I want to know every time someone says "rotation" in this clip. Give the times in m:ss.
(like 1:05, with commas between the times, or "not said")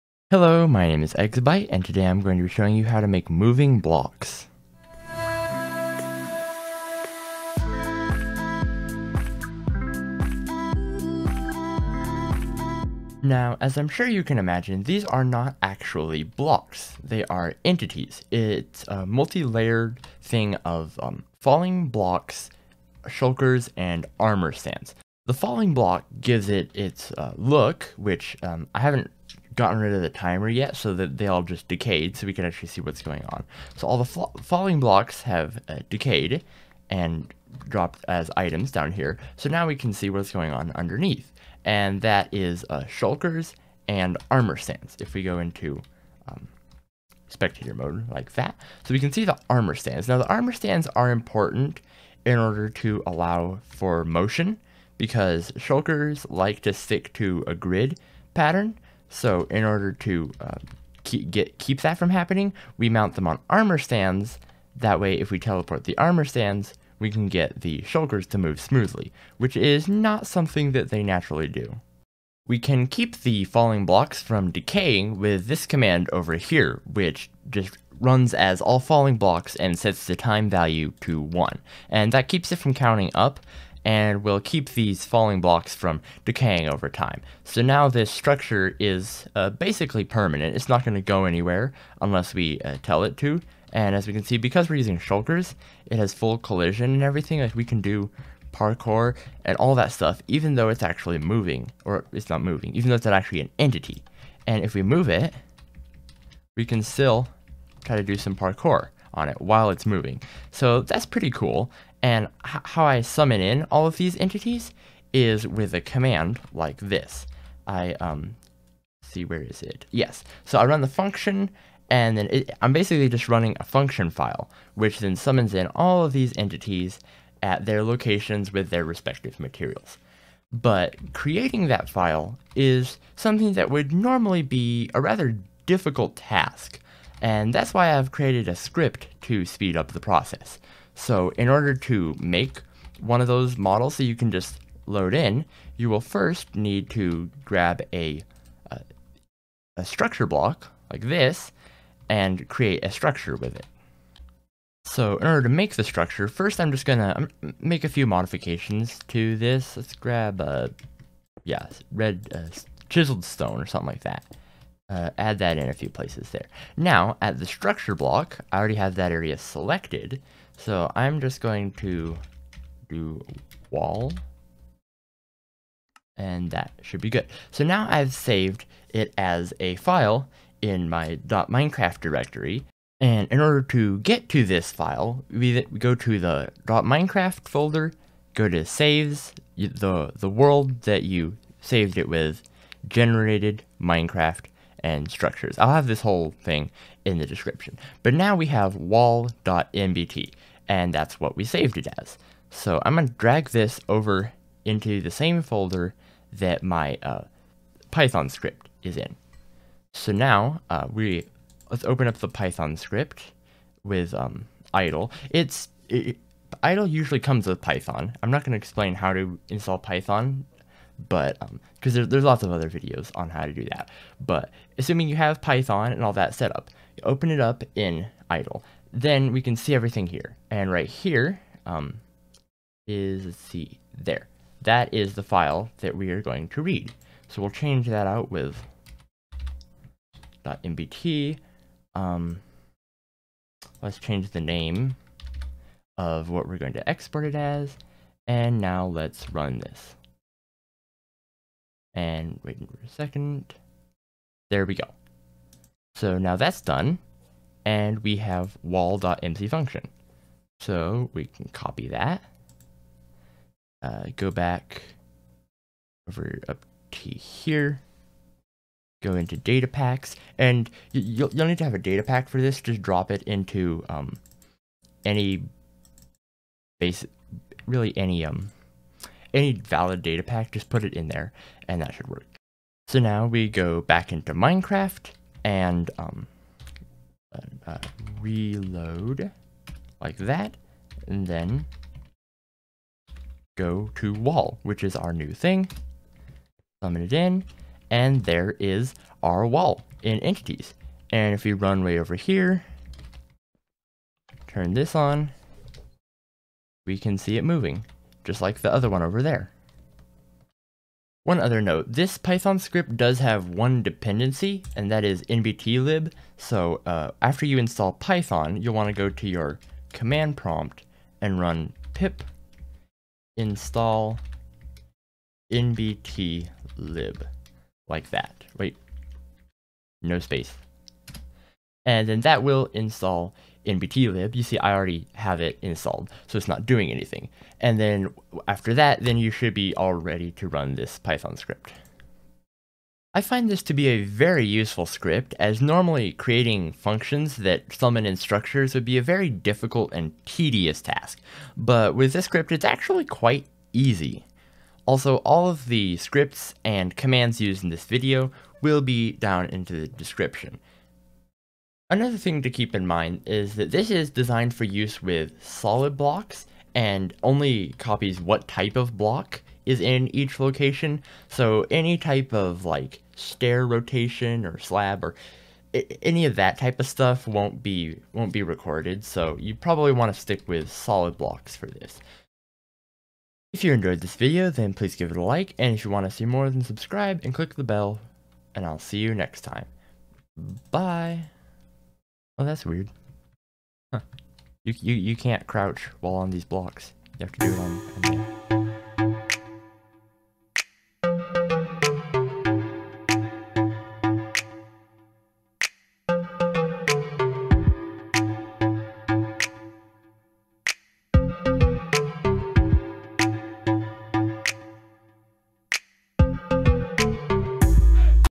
6:13.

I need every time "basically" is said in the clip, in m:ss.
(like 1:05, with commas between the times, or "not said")
1:29, 2:02.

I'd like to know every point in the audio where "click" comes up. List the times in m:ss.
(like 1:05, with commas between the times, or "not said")
6:27.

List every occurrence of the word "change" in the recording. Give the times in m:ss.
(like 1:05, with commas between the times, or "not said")
3:57, 4:03.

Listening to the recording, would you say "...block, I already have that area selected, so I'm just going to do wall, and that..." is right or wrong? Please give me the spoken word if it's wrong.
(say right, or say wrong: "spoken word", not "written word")
right.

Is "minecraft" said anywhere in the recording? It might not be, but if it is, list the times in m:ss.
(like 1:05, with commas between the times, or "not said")
3:01, 3:06, 3:13, 4:44.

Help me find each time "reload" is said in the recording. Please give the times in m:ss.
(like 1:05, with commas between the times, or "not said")
4:48.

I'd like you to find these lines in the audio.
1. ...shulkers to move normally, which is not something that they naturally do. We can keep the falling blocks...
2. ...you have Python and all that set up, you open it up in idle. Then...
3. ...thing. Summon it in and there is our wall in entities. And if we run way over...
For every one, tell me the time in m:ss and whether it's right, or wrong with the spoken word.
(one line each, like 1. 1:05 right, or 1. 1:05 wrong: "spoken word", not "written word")
1. 1:07 wrong: "smoothly", not "normally"
2. 3:45 right
3. 4:55 right.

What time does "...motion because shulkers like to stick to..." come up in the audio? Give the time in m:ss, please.
0:54.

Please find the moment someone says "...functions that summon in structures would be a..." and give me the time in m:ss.
5:46.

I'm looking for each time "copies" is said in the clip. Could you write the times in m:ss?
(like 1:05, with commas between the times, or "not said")
6:07.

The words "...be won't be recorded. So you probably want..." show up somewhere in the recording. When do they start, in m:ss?
6:17.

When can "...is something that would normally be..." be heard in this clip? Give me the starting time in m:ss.
2:12.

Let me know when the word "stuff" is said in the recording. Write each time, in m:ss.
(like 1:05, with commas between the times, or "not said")
1:39, 6:16.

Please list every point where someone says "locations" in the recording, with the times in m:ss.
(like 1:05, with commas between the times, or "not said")
2:07, 6:10.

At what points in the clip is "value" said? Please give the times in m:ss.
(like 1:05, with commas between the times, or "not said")
1:20.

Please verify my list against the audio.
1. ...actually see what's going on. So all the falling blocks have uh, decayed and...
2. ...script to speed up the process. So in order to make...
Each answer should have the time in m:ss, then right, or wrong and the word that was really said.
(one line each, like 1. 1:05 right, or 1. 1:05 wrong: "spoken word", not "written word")
1. 0:32 right
2. 2:18 right.